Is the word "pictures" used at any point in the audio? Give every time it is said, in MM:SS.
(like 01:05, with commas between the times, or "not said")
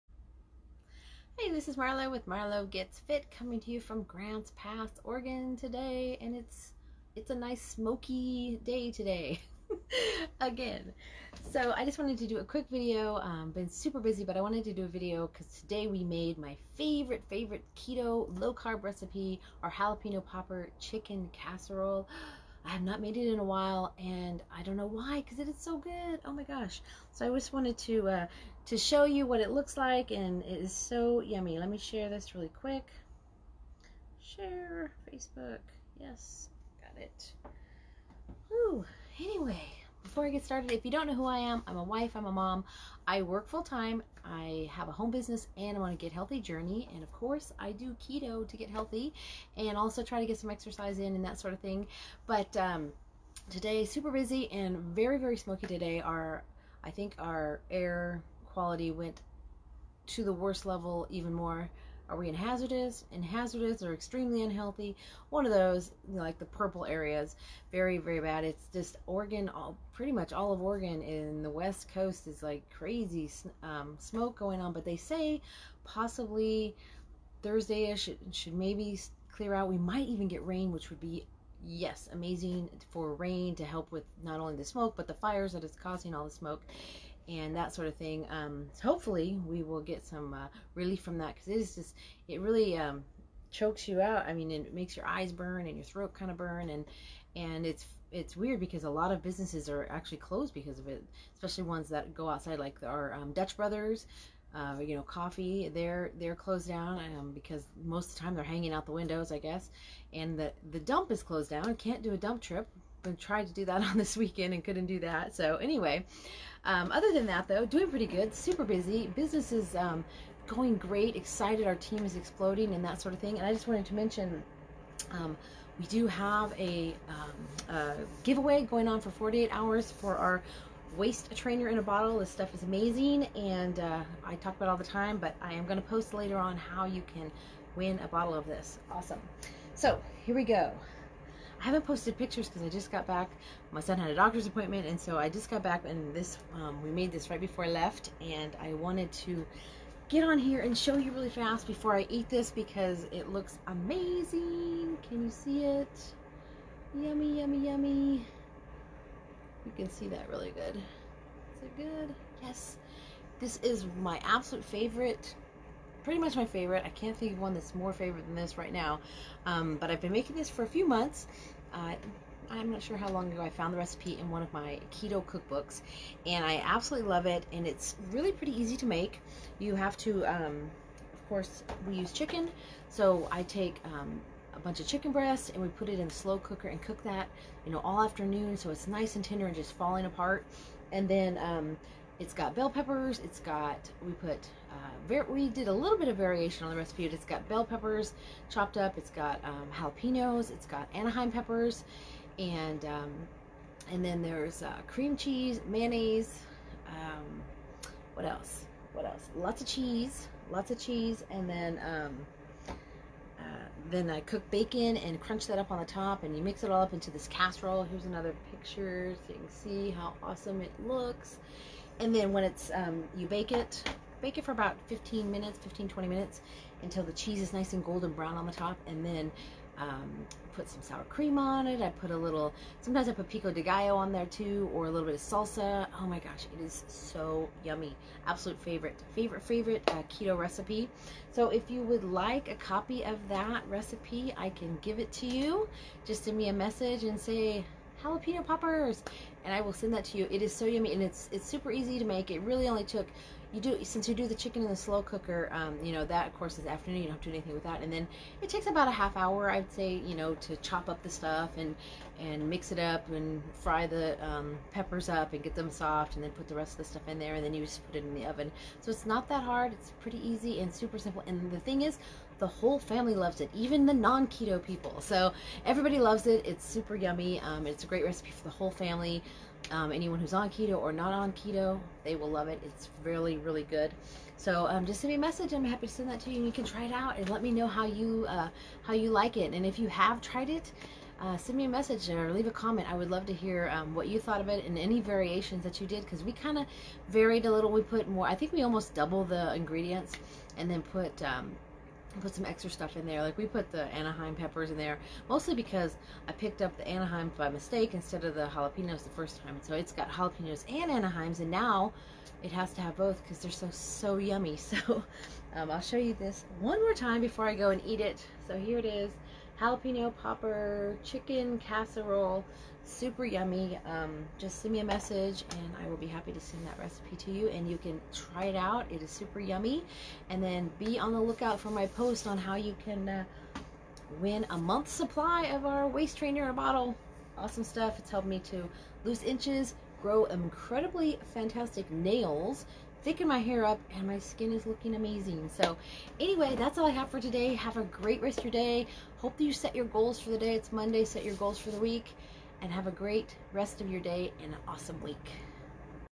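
02:22, 03:38.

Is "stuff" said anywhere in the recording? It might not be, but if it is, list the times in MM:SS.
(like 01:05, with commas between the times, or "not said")
02:12, 04:21, 04:26, 05:02, 05:37.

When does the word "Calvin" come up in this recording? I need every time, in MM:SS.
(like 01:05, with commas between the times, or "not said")
not said.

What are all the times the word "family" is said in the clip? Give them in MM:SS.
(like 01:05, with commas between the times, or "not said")
04:32, 04:38.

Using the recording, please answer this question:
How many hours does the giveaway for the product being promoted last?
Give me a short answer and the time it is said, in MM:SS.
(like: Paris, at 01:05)
48, at 02:09.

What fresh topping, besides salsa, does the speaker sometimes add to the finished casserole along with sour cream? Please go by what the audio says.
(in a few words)
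pico de gallo.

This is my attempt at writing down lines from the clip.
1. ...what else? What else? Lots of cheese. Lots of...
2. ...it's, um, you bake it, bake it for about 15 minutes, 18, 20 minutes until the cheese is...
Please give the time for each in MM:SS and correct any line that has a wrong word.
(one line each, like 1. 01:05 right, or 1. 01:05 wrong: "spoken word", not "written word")
1. 03:28 right
2. 03:42 wrong: "15", not "18".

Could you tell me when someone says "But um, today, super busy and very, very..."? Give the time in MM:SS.
00:52.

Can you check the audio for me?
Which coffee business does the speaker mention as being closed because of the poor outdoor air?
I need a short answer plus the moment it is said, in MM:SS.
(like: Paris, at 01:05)
Dutch Brothers, at 01:43.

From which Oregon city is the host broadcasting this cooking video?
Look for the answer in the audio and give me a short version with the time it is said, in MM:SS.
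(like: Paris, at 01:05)
Grants Pass, at 00:04.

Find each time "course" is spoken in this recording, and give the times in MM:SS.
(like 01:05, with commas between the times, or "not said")
00:47, 03:01, 04:16.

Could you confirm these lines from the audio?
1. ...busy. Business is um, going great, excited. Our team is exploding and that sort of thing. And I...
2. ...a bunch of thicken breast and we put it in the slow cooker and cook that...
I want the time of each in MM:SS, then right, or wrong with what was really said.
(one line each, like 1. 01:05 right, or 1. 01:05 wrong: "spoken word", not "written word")
1. 01:58 right
2. 03:04 wrong: "chicken", not "thicken".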